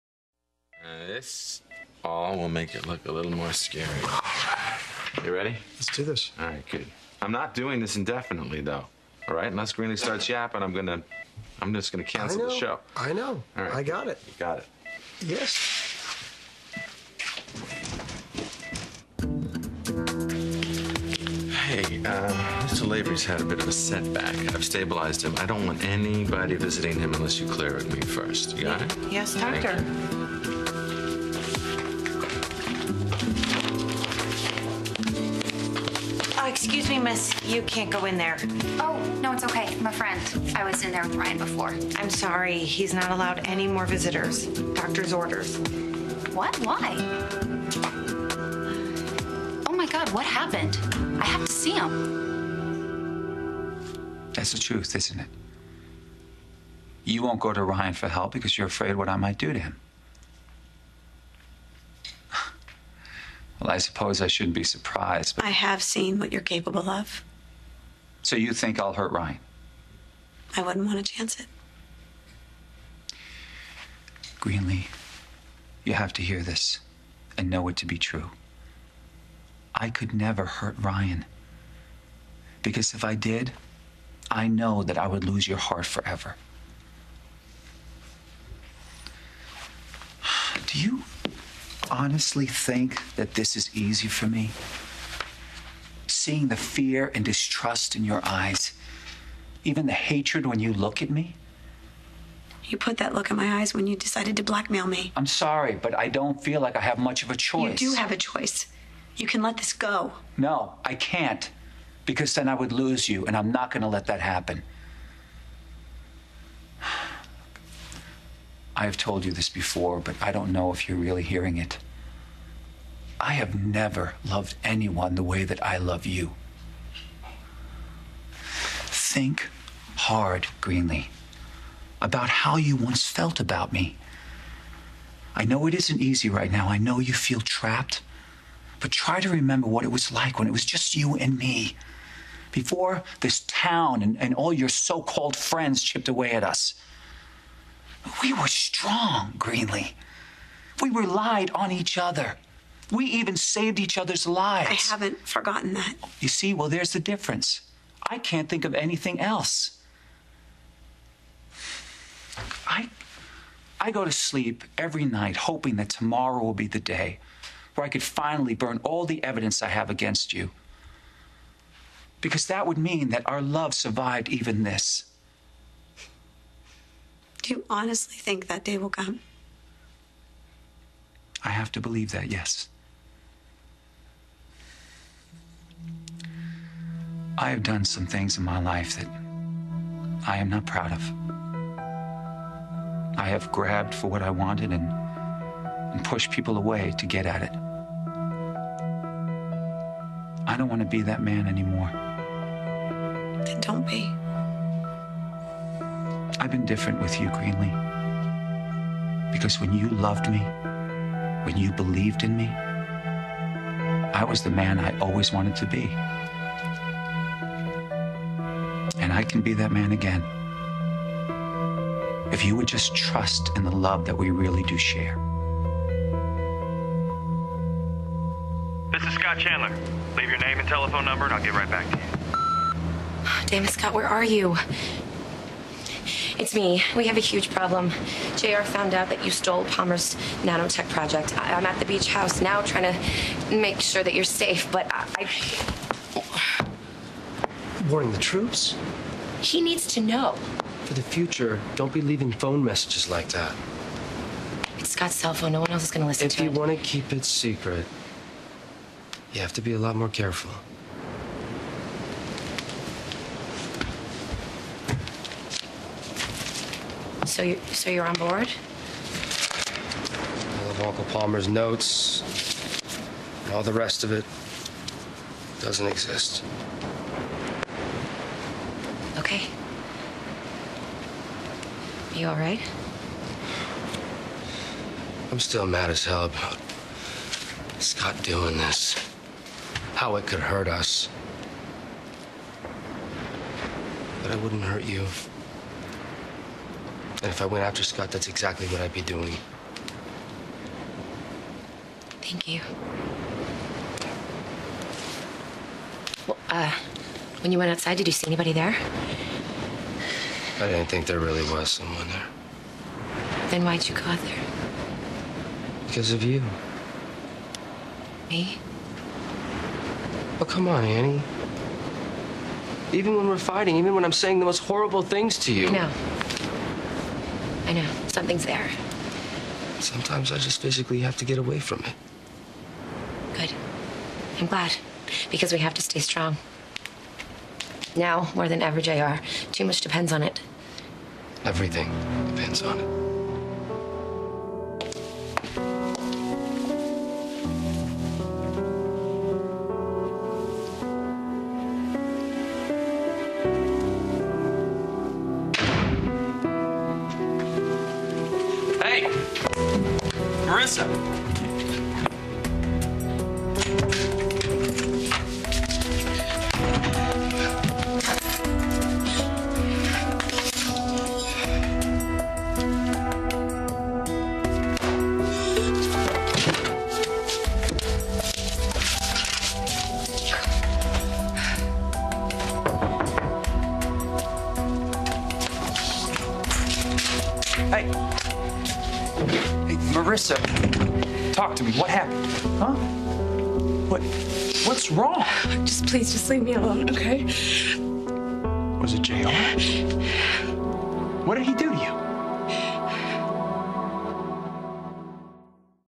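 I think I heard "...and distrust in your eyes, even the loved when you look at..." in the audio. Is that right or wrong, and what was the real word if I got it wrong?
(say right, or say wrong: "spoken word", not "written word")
wrong: "hatred", not "loved".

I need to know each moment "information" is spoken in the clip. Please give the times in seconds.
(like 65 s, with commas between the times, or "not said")
not said.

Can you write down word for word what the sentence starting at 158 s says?
I can't think of anything else.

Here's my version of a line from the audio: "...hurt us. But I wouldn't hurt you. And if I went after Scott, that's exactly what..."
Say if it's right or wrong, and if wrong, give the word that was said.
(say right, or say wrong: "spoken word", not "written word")
right.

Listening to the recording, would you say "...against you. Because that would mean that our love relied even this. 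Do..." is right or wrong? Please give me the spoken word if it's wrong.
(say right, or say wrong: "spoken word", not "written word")
wrong: "survived", not "relied".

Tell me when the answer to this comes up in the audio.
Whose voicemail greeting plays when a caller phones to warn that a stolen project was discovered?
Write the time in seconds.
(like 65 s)
229 s.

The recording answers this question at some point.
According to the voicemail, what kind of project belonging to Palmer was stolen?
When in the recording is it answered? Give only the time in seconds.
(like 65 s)
240 s.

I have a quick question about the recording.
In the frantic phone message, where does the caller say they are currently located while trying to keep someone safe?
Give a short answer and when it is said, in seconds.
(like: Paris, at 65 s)
the beach house, at 241 s.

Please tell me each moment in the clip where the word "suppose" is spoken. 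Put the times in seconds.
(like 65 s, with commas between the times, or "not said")
63 s.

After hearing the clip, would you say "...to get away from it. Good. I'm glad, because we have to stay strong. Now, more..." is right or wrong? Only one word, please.
right.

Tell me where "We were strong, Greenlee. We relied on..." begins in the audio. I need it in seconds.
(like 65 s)
148 s.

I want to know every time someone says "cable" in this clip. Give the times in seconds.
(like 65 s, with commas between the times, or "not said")
not said.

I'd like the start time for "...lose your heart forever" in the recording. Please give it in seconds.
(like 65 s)
85 s.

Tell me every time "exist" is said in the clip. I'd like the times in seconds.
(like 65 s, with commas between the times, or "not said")
275 s.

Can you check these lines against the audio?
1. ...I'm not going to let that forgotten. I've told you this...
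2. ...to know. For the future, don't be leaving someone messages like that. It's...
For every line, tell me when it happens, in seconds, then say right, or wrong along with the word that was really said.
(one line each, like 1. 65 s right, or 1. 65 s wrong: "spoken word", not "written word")
1. 113 s wrong: "happen", not "forgotten"
2. 249 s wrong: "phone", not "someone".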